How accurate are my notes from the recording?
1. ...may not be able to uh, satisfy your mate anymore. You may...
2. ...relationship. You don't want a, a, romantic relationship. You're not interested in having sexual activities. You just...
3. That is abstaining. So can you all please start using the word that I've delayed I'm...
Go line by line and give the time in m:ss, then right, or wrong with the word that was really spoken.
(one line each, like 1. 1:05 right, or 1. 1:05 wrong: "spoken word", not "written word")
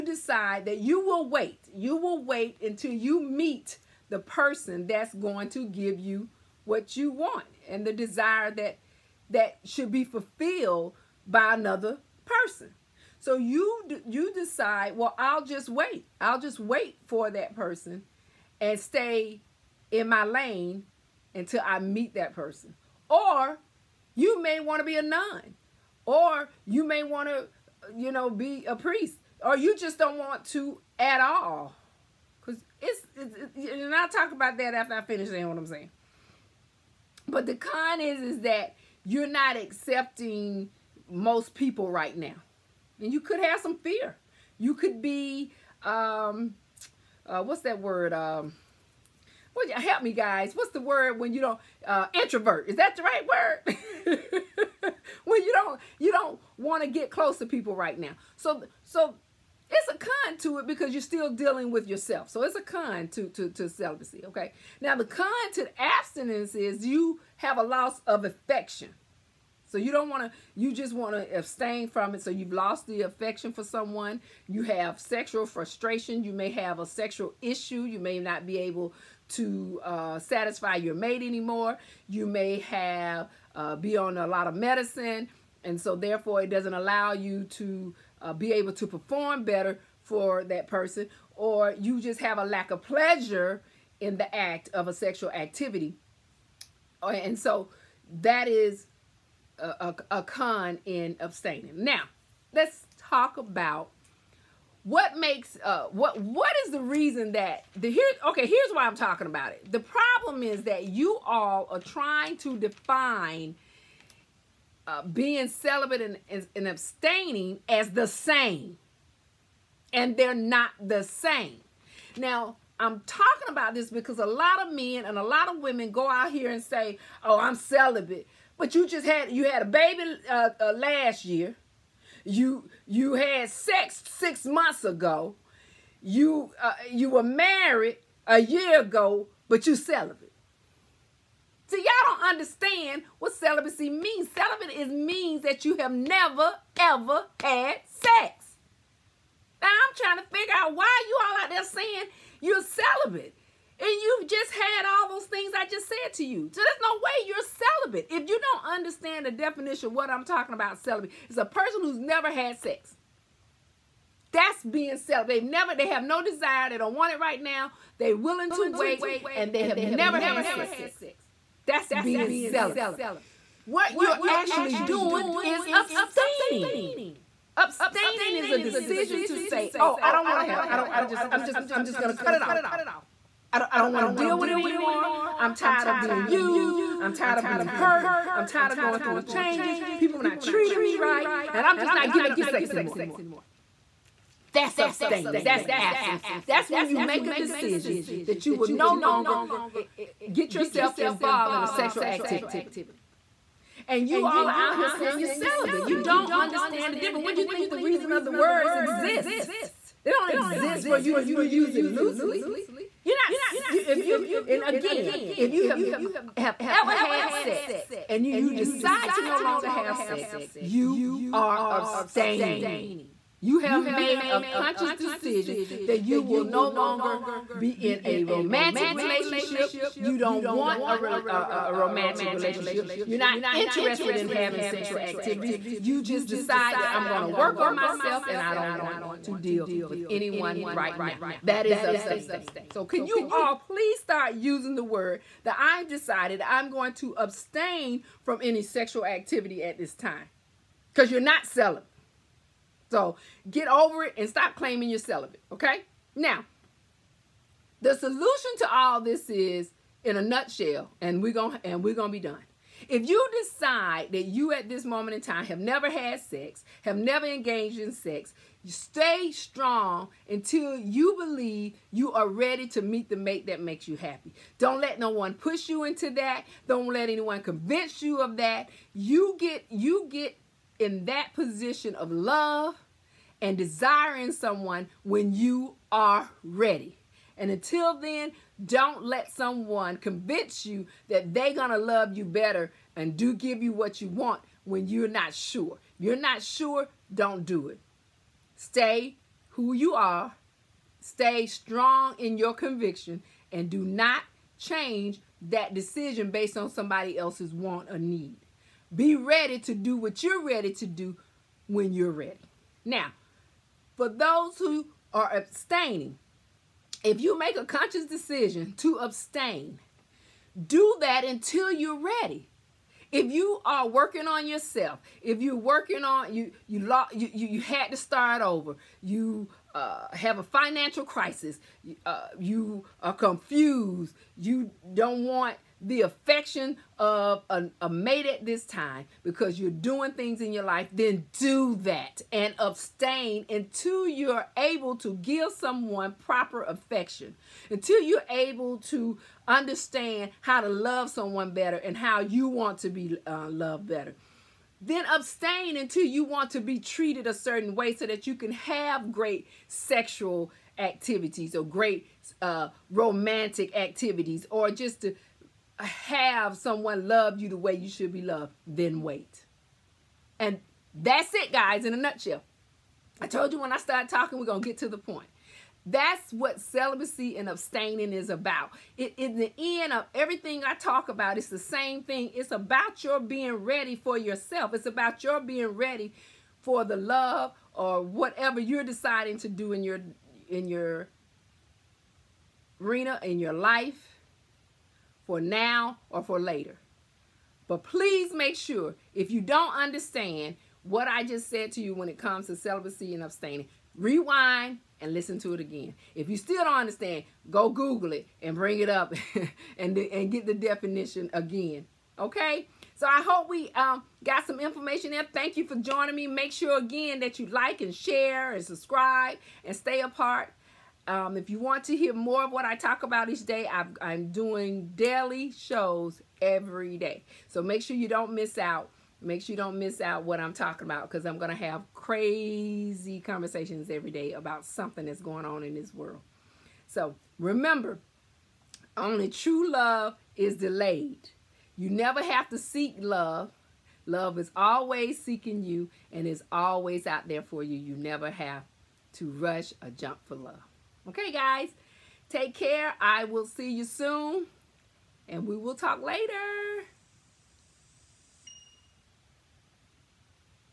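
1. 1:17 right
2. 3:48 right
3. 4:01 wrong: "decided", not "delayed".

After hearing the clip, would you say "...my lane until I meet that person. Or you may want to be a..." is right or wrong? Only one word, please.
right.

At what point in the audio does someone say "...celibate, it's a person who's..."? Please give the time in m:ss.
2:40.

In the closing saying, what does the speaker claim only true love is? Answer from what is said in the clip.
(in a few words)
delayed.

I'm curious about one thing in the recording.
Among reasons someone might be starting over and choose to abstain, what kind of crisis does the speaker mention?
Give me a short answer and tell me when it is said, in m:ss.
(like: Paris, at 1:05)
financial crisis, at 5:30.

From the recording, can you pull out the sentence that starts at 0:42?
And you could have some fear.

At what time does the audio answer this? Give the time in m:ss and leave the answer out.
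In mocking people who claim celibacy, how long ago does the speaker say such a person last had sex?
2:14.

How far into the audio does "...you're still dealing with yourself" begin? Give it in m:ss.
1:00.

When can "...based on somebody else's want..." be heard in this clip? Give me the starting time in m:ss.
5:06.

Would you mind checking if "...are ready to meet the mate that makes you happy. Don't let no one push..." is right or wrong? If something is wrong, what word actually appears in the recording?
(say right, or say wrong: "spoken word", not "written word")
right.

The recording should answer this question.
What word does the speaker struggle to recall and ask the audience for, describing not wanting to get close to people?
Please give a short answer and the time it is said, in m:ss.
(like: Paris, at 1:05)
introvert, at 0:52.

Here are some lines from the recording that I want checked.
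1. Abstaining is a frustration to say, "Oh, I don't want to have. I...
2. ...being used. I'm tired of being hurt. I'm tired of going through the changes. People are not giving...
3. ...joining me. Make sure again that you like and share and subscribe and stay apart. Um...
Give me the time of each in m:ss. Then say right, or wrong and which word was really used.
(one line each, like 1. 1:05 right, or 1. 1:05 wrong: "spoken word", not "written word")
1. 2:57 wrong: "decision", not "frustration"
2. 3:05 wrong: "treating", not "giving"
3. 6:55 right.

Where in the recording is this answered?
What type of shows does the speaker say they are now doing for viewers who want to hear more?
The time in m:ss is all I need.
7:04.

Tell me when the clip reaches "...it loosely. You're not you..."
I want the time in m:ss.
3:31.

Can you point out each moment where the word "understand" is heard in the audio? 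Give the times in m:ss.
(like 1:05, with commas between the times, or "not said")
2:22, 2:38, 3:26, 5:49, 6:39, 6:46.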